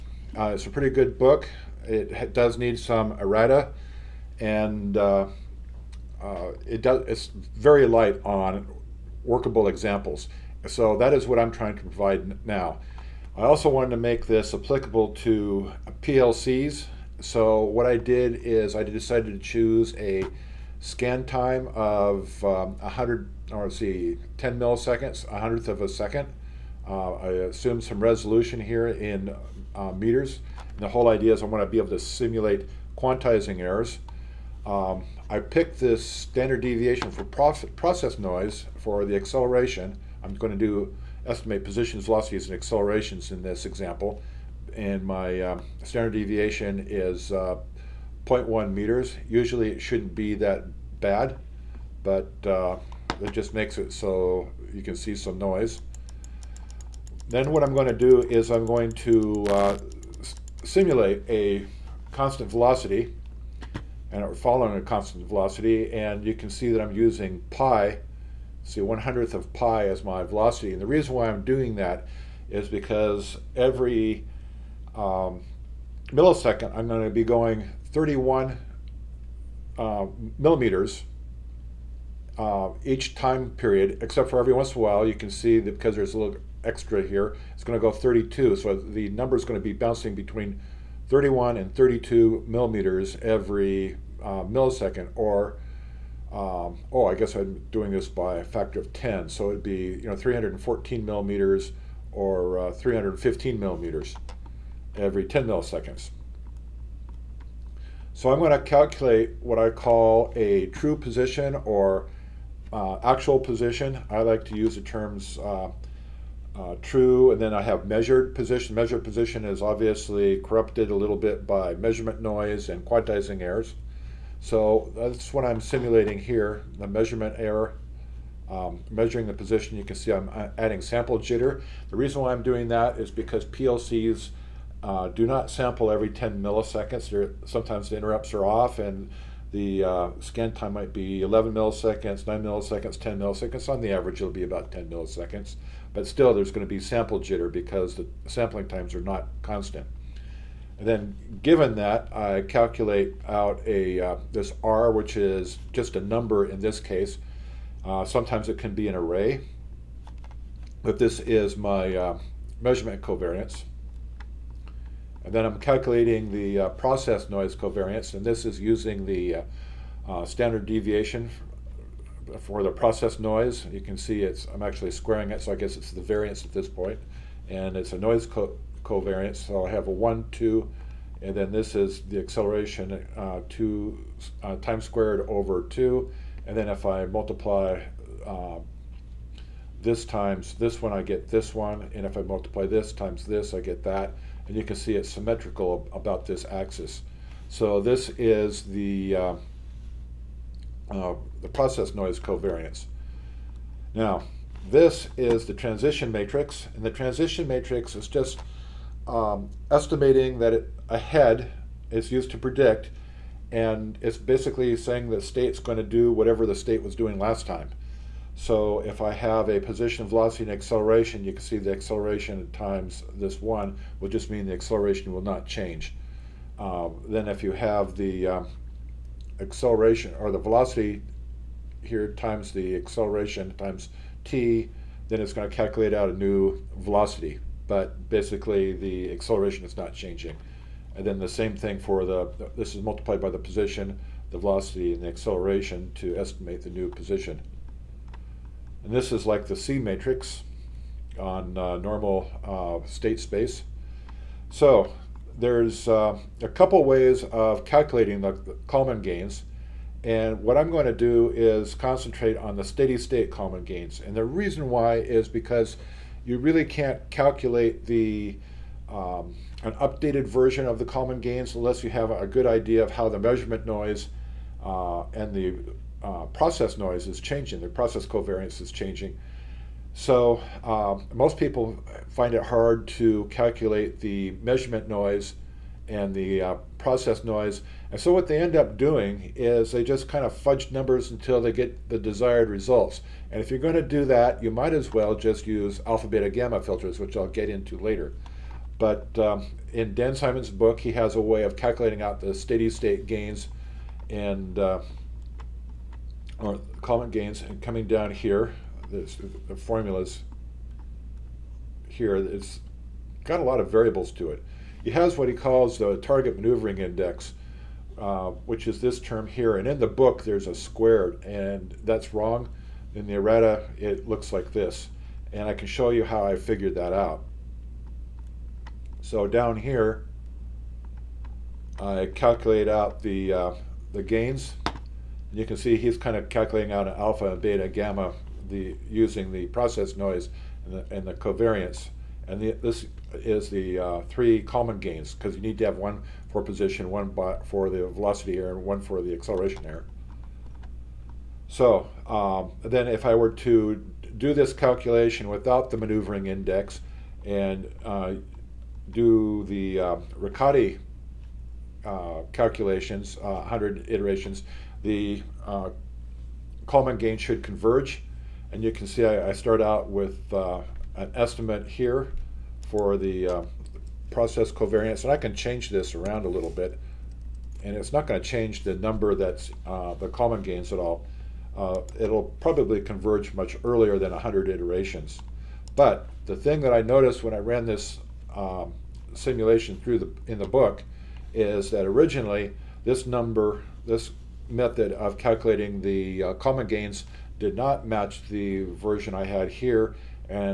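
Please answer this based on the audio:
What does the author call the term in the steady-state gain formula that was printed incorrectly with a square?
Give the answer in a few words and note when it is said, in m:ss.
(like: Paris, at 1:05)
target maneuvering index, at 5:15.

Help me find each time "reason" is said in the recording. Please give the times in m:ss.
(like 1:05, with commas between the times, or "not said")
1:10, 2:11, 4:24.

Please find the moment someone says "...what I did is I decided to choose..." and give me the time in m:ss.
0:17.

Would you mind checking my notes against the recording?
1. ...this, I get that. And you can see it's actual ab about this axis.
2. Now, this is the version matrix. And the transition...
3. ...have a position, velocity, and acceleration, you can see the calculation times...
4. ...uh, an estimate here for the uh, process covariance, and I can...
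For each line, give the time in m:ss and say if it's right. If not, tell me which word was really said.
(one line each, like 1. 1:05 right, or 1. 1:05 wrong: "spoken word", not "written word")
1. 3:13 wrong: "symmetrical", not "actual"
2. 3:23 wrong: "transition", not "version"
3. 3:39 wrong: "acceleration", not "calculation"
4. 6:10 right.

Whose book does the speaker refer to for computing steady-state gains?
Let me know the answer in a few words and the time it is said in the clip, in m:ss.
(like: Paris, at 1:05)
Dan Simon, at 4:59.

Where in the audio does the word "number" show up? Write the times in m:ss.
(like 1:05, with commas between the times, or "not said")
1:29, 2:36, 4:50, 6:18, 6:33.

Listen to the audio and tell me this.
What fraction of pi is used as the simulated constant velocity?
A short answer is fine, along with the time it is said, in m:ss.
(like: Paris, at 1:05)
1 hundredth, at 1:08.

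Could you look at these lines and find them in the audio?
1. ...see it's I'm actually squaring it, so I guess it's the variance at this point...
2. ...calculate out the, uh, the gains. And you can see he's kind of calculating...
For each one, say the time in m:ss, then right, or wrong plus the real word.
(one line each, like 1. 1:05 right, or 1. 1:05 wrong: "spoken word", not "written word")
1. 2:53 right
2. 5:32 right.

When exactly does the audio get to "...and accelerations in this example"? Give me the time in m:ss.
0:42.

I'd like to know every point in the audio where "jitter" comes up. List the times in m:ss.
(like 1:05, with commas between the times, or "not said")
2:11, 2:27.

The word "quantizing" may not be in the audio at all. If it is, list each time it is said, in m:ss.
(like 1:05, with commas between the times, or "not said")
0:32, 2:02.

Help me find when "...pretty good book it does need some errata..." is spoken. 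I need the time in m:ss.
0:00.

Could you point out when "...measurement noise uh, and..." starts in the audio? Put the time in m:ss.
4:33.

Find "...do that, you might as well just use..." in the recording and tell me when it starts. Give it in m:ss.
4:53.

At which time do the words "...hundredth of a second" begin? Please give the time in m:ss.
0:25.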